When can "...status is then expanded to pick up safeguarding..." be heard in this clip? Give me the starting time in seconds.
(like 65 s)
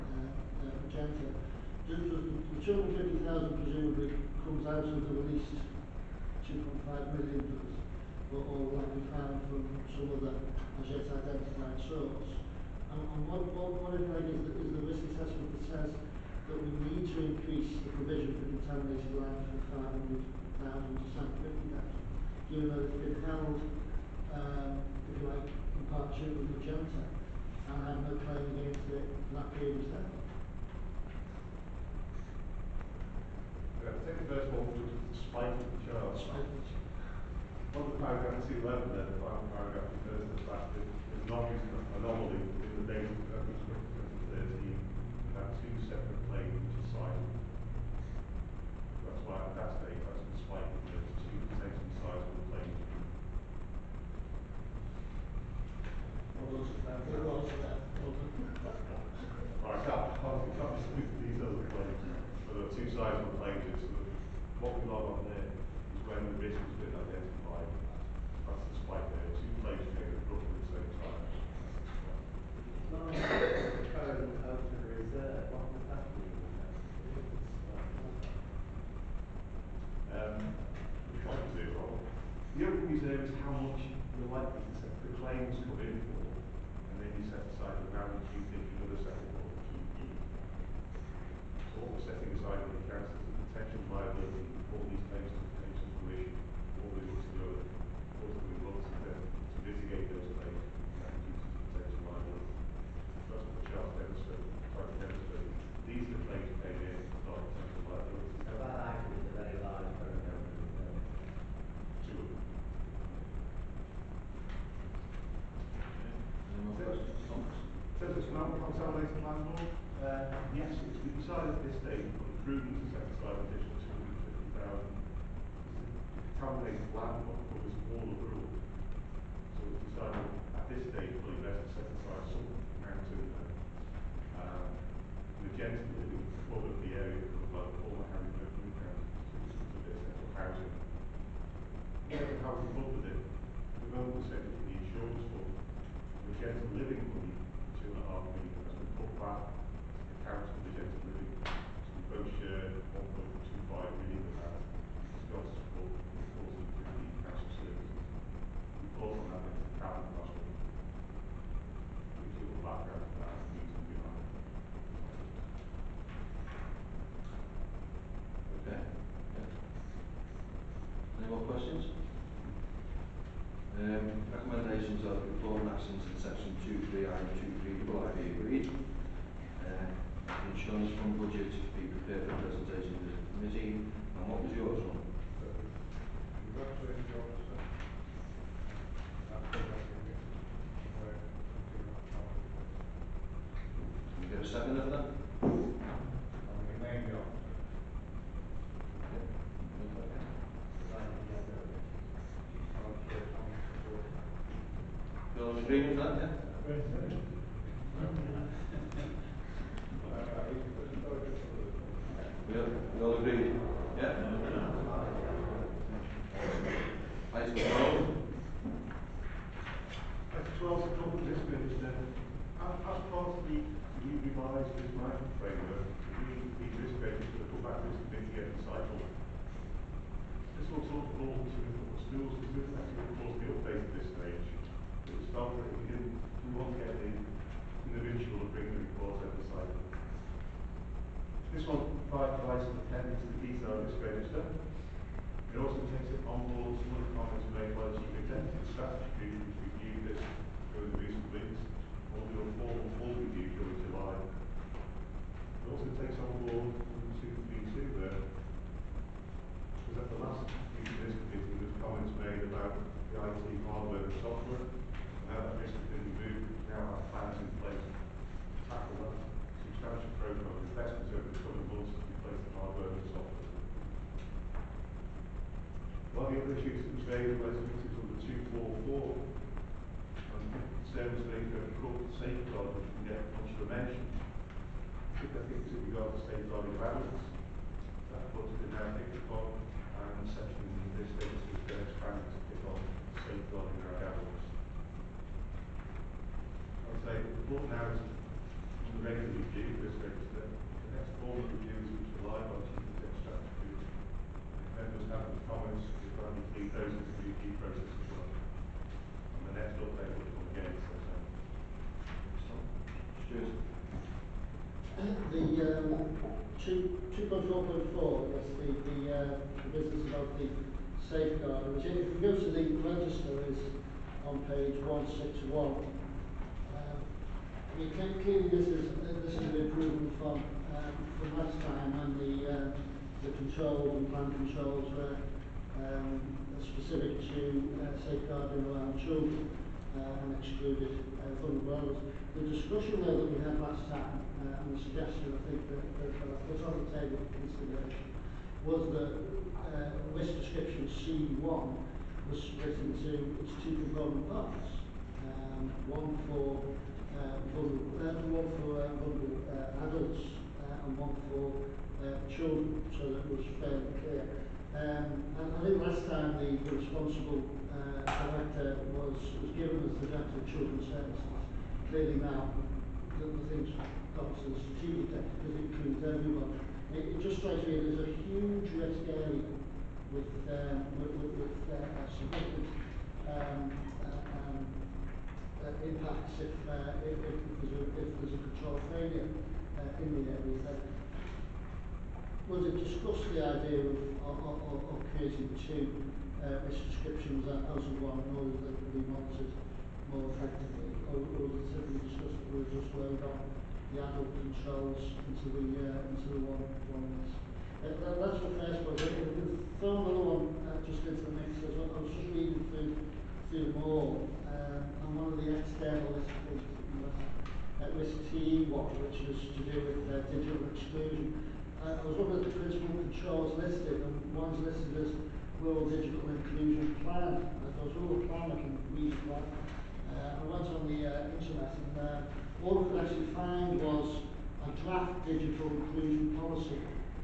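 291 s.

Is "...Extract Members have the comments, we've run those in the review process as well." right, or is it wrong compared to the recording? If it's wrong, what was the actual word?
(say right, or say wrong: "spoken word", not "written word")
right.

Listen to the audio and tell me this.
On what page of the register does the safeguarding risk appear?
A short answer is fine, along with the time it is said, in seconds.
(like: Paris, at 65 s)
161, at 324 s.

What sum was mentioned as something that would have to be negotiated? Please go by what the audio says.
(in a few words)
1.25 million.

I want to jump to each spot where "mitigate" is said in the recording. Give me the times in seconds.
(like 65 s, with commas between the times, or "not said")
99 s.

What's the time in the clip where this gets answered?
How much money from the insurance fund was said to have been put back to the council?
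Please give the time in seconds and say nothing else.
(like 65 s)
147 s.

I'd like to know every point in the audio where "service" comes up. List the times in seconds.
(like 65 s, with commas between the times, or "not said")
280 s, 370 s.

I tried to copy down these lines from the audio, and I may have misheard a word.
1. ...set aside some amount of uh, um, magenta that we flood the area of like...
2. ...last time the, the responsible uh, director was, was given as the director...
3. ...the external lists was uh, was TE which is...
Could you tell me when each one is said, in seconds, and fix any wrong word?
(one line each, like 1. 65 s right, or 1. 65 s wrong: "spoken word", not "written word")
1. 131 s right
2. 365 s right
3. 415 s right.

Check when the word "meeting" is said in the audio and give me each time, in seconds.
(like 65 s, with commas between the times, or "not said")
260 s, 277 s.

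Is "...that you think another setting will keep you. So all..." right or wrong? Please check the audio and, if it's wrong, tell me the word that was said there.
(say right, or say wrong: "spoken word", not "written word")
right.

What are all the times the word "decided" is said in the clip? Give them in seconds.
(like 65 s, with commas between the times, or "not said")
121 s, 129 s.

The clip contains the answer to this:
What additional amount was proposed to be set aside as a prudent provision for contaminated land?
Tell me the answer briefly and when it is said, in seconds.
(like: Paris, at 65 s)
250,000, at 123 s.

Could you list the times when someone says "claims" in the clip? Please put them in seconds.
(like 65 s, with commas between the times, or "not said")
28 s, 85 s, 95 s, 100 s.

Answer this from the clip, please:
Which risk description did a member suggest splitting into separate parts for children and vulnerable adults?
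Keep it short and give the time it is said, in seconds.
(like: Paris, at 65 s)
C1, at 350 s.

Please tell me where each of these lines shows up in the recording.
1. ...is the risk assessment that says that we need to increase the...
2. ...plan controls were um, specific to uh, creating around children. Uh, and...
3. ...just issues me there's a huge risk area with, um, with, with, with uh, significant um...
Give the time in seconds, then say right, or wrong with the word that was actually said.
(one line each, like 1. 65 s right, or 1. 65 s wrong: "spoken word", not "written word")
1. 14 s right
2. 334 s wrong: "safeguarding", not "creating"
3. 377 s wrong: "strikes", not "issues".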